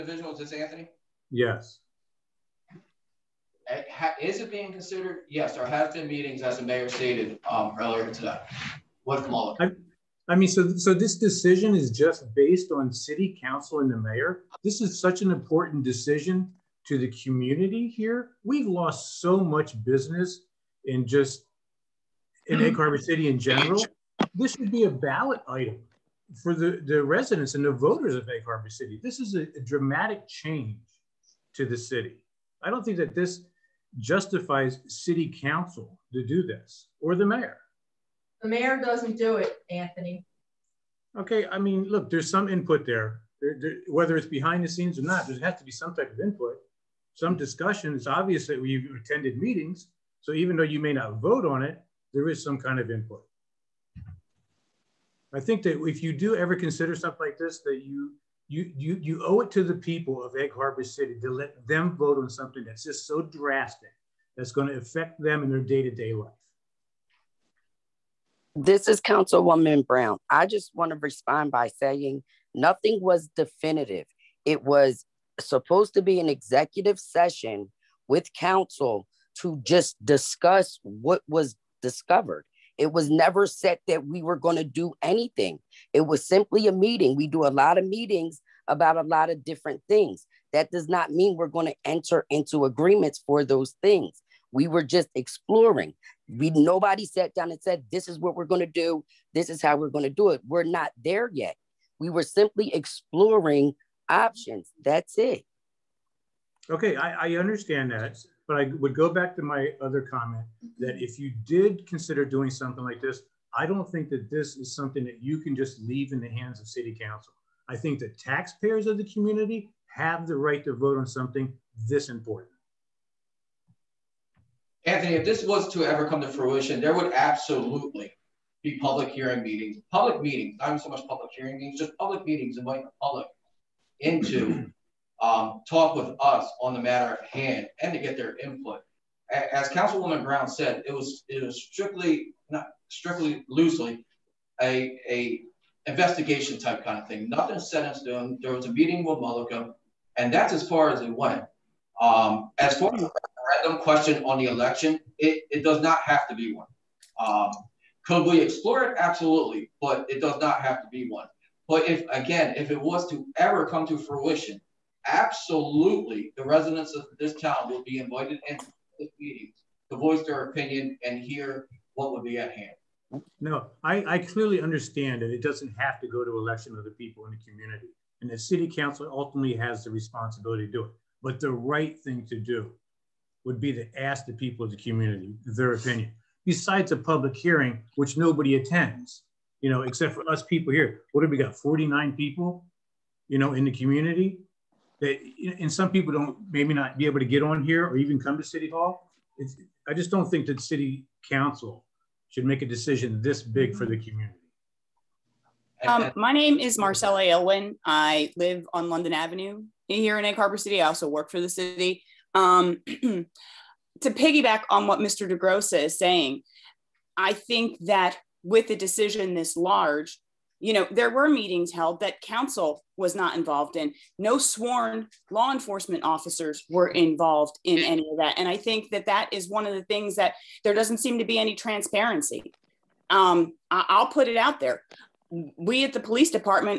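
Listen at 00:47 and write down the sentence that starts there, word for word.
It's obvious that we've attended meetings.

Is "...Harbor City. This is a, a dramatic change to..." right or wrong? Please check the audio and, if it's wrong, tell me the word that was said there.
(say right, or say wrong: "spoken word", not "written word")
right.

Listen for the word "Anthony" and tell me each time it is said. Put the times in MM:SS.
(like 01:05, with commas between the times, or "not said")
00:00, 00:39, 02:04.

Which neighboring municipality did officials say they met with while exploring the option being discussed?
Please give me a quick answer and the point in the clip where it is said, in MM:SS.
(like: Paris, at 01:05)
Mullica, at 02:29.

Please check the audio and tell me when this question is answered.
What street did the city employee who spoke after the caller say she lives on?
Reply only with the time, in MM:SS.
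03:28.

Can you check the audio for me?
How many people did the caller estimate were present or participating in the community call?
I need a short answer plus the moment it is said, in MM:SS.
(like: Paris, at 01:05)
49, at 03:11.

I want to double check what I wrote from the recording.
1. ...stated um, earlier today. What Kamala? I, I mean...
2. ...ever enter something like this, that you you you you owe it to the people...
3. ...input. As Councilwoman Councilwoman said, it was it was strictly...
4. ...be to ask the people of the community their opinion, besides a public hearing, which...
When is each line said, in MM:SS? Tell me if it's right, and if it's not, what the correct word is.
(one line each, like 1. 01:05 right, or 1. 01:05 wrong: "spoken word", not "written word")
1. 00:06 right
2. 00:56 wrong: "consider", not "enter"
3. 02:18 wrong: "Brown", not "Councilwoman"
4. 03:03 right.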